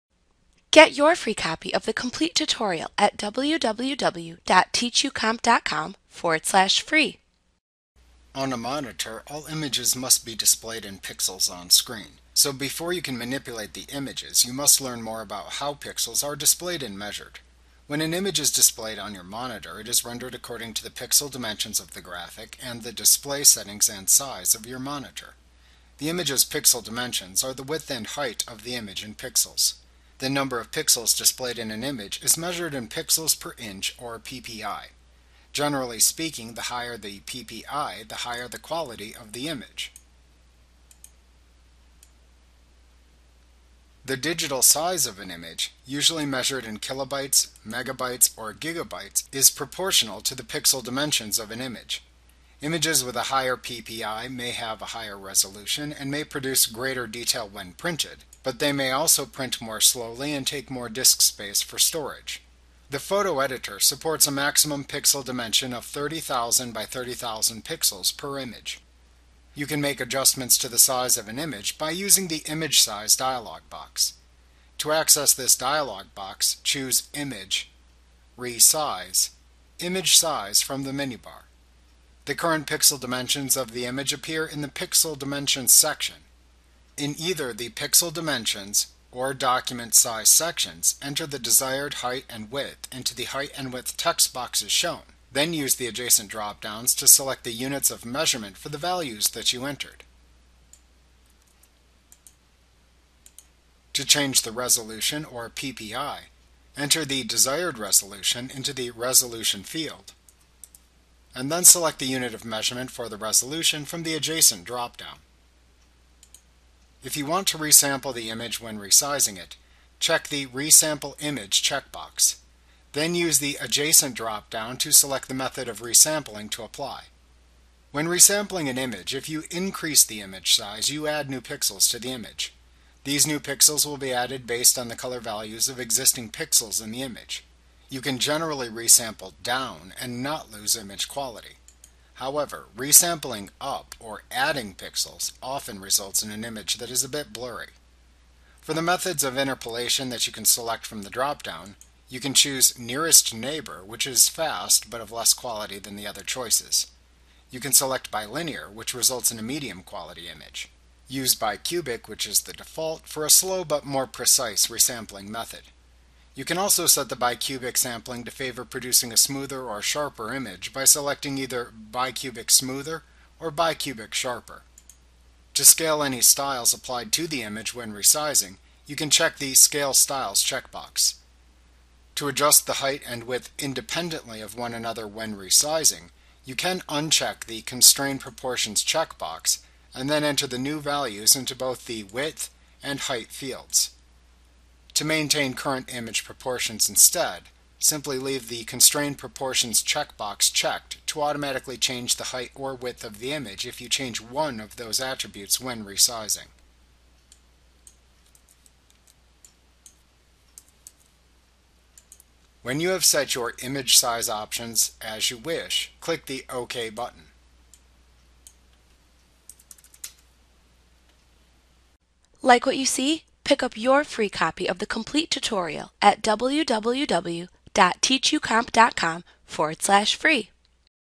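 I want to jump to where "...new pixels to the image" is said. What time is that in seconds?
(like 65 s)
131 s.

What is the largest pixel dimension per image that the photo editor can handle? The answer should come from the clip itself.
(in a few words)
30,000 by 30,000.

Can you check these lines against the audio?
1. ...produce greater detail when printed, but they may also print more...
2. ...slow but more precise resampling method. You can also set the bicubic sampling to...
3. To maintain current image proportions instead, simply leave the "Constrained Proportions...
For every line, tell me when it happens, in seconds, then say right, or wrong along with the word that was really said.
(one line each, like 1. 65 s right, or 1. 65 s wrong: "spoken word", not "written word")
1. 56 s right
2. 163 s right
3. 194 s right.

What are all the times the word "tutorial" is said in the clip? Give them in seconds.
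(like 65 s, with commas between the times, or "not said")
2 s, 225 s.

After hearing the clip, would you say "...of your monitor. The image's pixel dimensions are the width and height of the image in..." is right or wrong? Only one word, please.
right.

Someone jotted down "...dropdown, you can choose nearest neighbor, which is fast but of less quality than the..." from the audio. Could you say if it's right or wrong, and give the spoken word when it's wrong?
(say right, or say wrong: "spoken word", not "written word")
right.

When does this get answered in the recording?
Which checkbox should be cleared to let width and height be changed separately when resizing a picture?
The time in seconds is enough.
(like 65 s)
187 s.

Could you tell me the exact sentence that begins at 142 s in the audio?
However, resampling up or adding pixels often results in an image that is a bit blurry.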